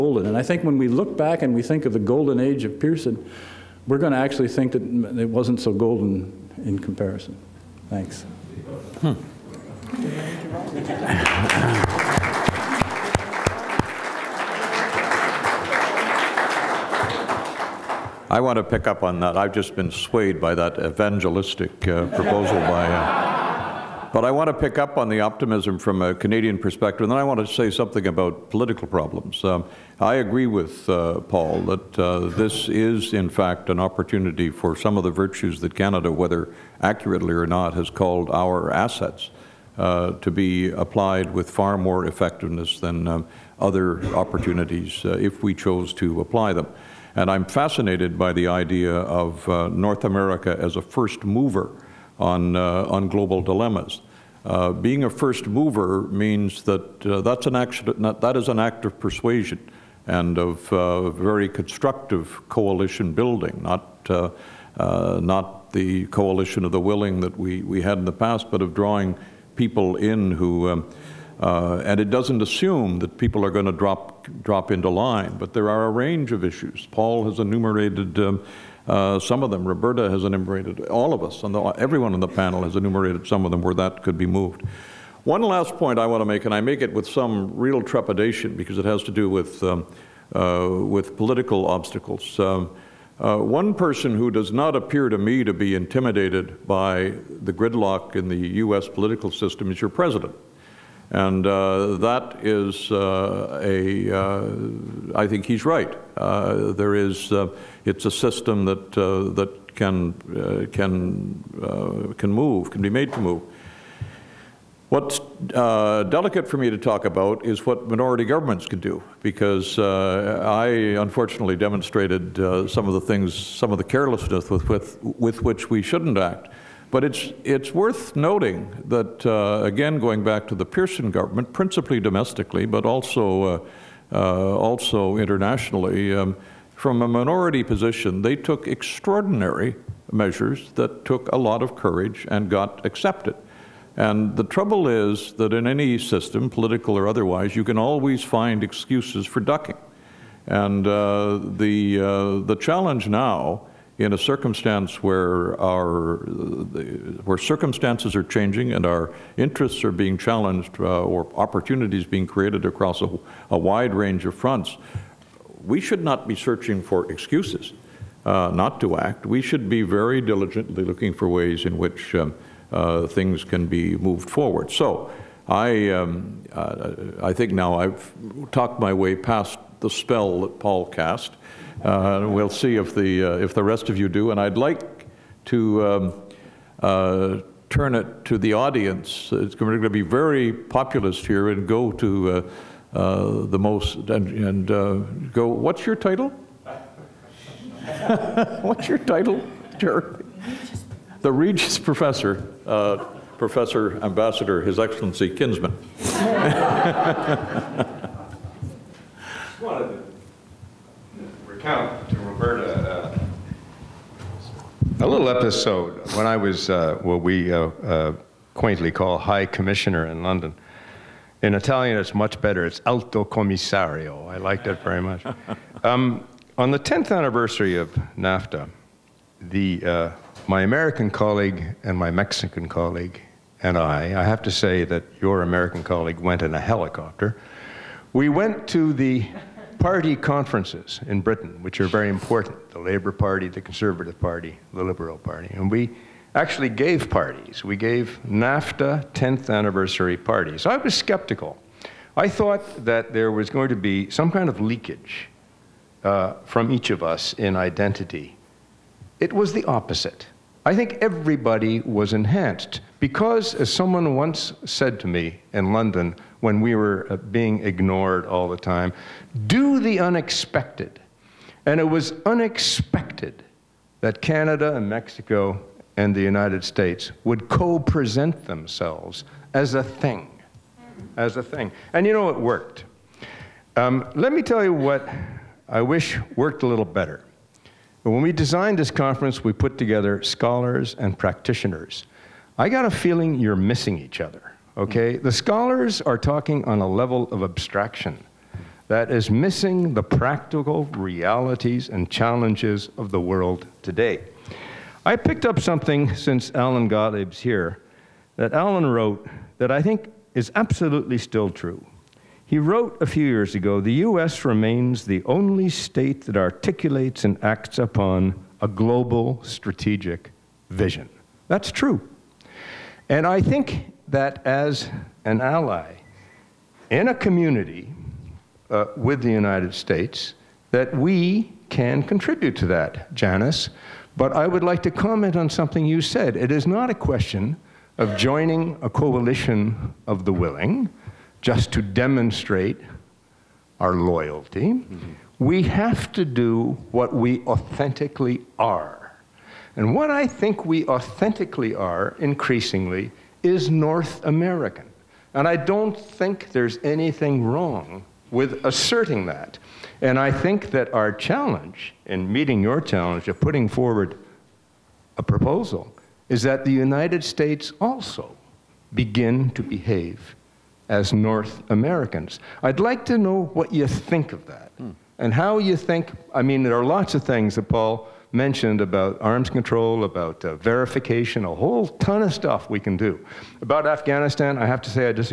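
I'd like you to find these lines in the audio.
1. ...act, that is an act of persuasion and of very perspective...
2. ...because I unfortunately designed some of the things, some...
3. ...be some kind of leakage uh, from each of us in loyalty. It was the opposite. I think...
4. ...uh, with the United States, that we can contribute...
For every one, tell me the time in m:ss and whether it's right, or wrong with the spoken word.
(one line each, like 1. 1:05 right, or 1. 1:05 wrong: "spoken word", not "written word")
1. 0:57 wrong: "constructive", not "perspective"
2. 1:59 wrong: "demonstrated", not "designed"
3. 4:13 wrong: "identity", not "loyalty"
4. 5:28 right.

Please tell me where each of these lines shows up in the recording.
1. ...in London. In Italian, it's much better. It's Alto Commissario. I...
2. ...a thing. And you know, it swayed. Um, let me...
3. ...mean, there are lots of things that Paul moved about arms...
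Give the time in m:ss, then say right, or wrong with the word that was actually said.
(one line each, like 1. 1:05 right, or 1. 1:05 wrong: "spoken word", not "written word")
1. 3:40 right
2. 4:41 wrong: "worked", not "swayed"
3. 6:16 wrong: "mentioned", not "moved".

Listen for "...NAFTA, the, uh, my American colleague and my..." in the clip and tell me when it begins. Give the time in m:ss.
3:48.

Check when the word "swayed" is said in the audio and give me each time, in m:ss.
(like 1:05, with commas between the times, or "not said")
0:19.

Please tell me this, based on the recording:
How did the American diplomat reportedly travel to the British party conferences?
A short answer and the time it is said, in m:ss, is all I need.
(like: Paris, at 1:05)
In a helicopter, at 3:56.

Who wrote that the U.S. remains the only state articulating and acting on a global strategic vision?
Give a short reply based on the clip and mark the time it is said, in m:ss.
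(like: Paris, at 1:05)
Allan Gotlieb, at 5:06.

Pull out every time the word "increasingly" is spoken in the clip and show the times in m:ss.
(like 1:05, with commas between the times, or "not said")
5:52.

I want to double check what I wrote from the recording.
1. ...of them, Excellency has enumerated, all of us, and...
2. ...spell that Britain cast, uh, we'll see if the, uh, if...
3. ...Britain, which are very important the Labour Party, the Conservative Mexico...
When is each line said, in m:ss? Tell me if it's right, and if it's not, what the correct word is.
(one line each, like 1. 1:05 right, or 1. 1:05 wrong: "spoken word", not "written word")
1. 1:19 wrong: "Roberta", not "Excellency"
2. 2:59 wrong: "Paul", not "Britain"
3. 4:01 wrong: "Party", not "Mexico".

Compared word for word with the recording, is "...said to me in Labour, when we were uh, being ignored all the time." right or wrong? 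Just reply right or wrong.
wrong.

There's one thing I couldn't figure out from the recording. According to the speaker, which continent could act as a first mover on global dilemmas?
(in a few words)
North America.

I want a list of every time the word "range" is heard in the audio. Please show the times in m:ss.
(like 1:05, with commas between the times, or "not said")
1:15, 2:43.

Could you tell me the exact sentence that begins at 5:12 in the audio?
He wrote a few years ago the U.S.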